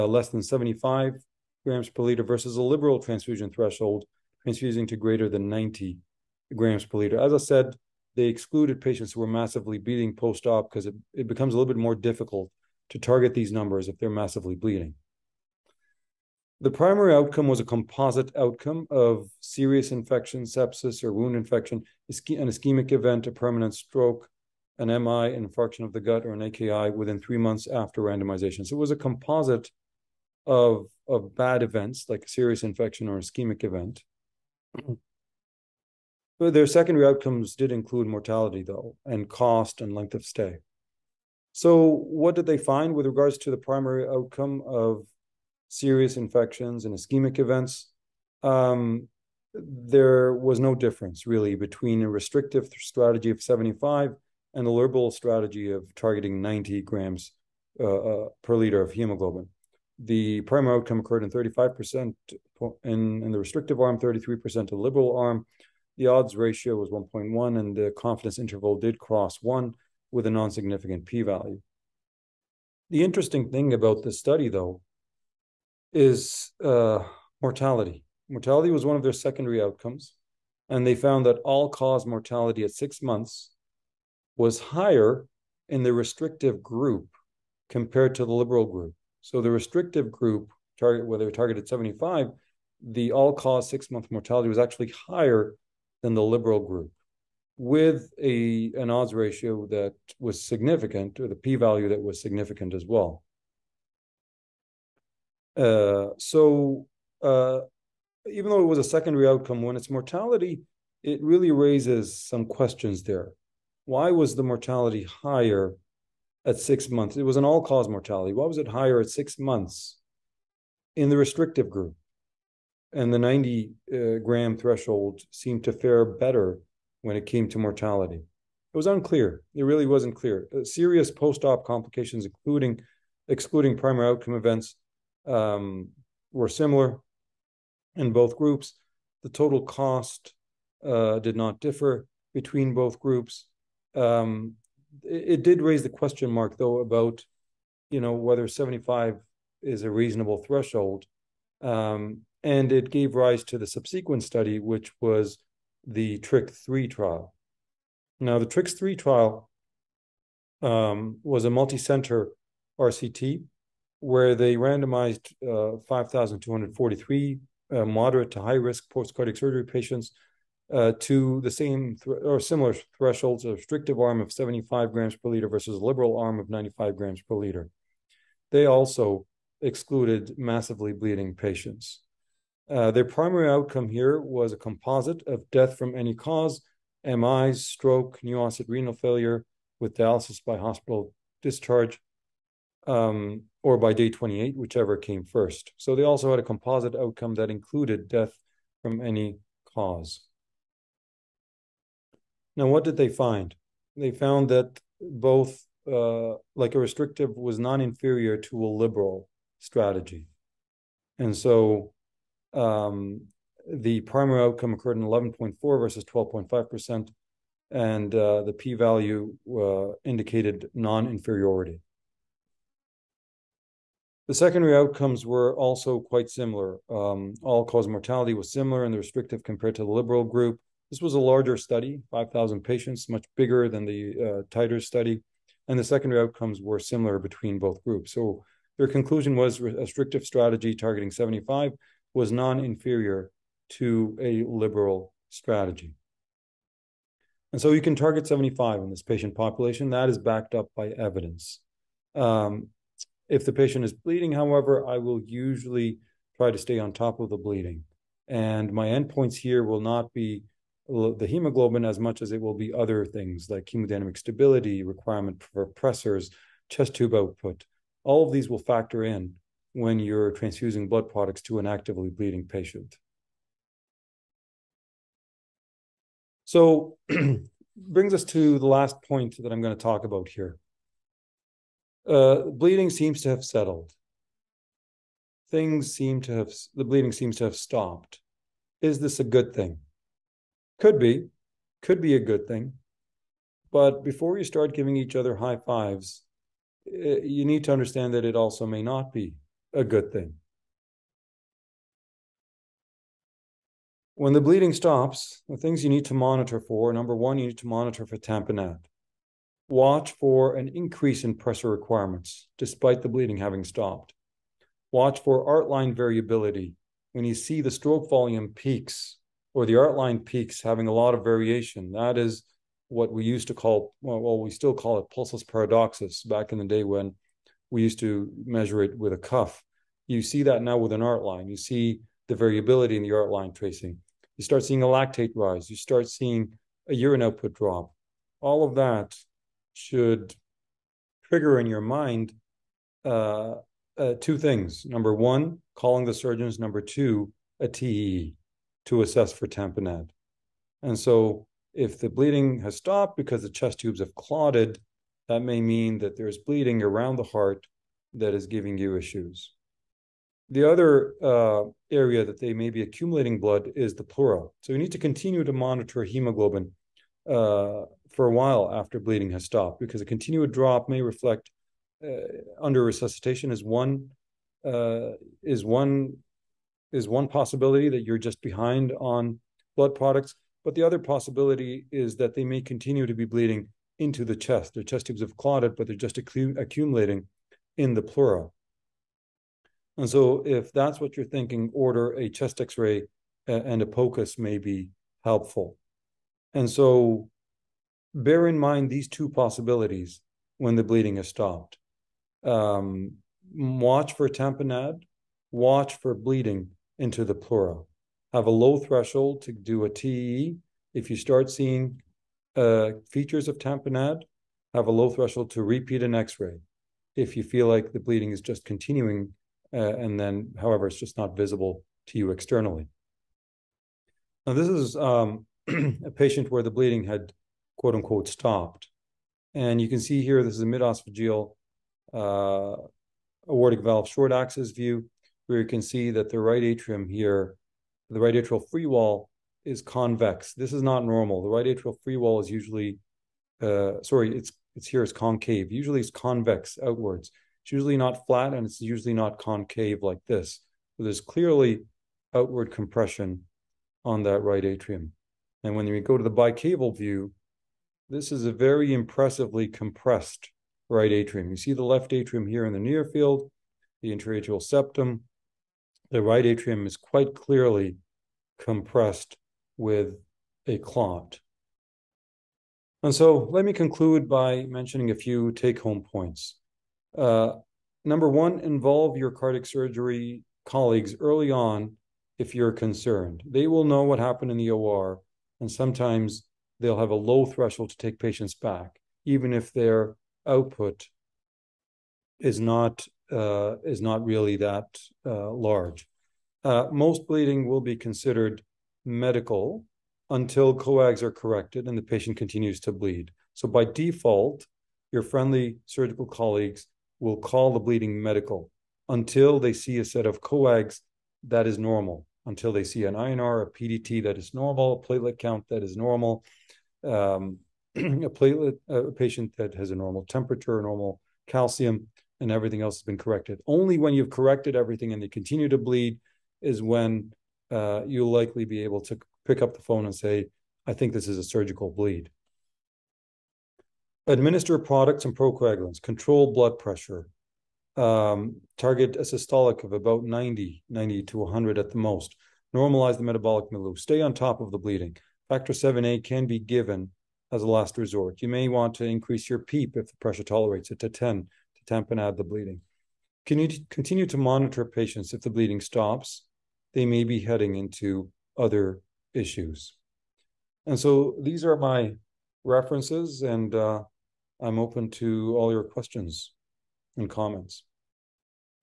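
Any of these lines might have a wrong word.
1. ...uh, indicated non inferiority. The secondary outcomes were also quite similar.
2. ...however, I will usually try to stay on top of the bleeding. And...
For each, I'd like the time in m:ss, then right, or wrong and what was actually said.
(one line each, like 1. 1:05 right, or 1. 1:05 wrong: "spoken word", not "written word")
1. 3:39 right
2. 4:14 right.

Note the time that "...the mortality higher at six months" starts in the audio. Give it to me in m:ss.
1:54.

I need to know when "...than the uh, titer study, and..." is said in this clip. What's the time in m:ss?
3:53.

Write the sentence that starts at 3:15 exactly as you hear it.
So they also had a composite outcome that included death from any cause.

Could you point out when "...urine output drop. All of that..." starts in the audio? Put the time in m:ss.
5:36.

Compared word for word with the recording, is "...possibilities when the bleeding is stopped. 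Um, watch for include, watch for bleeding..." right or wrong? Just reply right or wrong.
wrong.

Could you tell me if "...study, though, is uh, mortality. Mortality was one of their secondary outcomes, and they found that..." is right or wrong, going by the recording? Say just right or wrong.
right.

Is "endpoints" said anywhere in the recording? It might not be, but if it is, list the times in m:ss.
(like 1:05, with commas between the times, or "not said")
4:18.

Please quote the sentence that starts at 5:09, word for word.
Watch for an increase in pressure requirements despite the bleeding having stopped.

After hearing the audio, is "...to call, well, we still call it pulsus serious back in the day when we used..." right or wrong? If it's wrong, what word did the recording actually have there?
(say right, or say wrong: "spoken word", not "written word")
wrong: "paradoxus", not "serious".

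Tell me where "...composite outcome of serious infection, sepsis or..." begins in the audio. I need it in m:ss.
0:17.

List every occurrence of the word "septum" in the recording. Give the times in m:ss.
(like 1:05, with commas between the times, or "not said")
7:44.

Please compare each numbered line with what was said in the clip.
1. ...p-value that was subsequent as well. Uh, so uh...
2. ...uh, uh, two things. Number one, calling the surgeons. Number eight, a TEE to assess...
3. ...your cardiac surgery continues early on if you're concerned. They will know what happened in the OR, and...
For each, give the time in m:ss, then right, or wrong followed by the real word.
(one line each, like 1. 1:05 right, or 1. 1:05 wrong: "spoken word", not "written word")
1. 1:41 wrong: "significant", not "subsequent"
2. 5:43 wrong: "two", not "eight"
3. 7:59 wrong: "colleagues", not "continues".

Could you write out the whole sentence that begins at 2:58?
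They also excluded massively bleeding patients.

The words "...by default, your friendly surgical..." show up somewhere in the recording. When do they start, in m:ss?
8:23.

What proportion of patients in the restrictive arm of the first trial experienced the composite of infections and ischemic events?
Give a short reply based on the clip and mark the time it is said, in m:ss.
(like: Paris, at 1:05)
35%, at 1:01.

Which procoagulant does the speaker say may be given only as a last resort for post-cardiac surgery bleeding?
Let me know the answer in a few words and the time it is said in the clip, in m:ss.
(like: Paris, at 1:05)
Factor 7A, at 9:05.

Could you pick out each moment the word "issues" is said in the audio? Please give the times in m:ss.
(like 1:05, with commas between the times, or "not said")
5:58, 9:19.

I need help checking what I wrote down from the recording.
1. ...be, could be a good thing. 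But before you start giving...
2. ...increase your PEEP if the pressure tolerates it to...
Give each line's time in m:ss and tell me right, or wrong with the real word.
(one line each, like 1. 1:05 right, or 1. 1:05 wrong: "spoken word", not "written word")
1. 4:50 right
2. 9:09 right.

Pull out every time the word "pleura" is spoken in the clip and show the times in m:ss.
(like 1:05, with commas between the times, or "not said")
6:04, 6:28.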